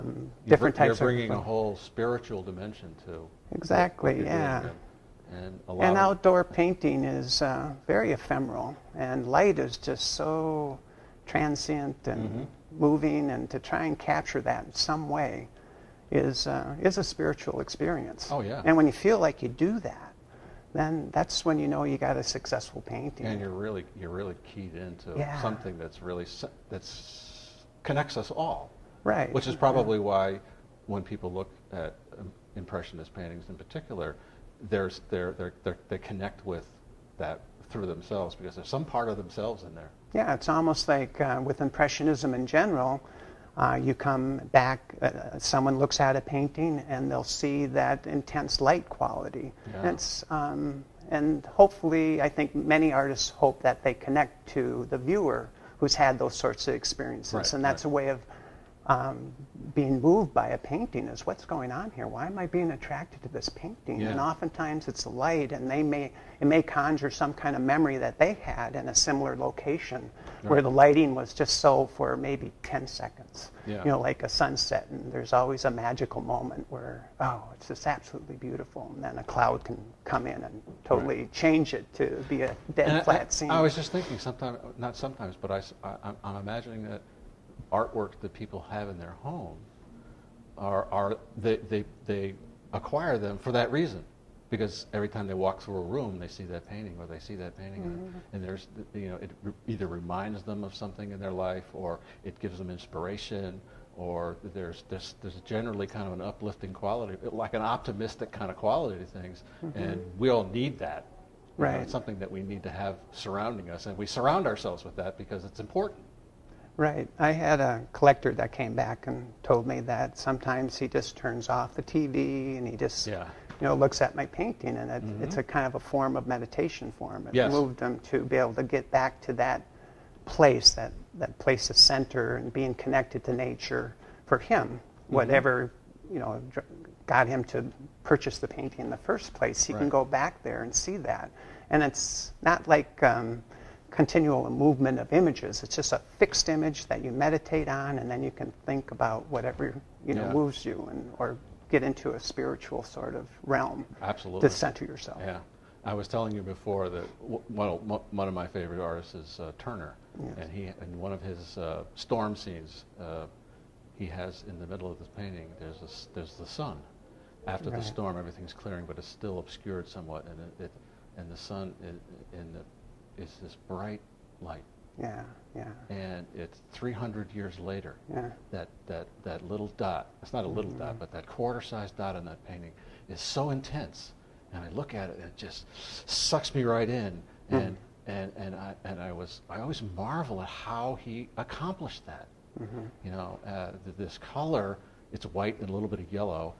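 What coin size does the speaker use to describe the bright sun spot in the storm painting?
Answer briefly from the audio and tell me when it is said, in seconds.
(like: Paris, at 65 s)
quarter-sized, at 181 s.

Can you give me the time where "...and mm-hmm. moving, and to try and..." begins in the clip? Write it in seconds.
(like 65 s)
12 s.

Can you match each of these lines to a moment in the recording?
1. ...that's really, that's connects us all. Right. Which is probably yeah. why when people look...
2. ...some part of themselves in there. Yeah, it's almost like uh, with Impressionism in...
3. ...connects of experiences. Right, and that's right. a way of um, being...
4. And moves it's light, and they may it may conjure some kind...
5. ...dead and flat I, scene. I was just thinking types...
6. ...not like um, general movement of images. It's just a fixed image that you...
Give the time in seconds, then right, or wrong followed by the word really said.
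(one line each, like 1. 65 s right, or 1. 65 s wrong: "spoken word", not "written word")
1. 25 s right
2. 38 s right
3. 56 s wrong: "sorts", not "connects"
4. 64 s wrong: "oftentimes", not "moves"
5. 82 s wrong: "sometimes", not "types"
6. 142 s wrong: "continual", not "general".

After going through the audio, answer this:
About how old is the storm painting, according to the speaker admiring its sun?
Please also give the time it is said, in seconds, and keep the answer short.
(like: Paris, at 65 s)
300, at 176 s.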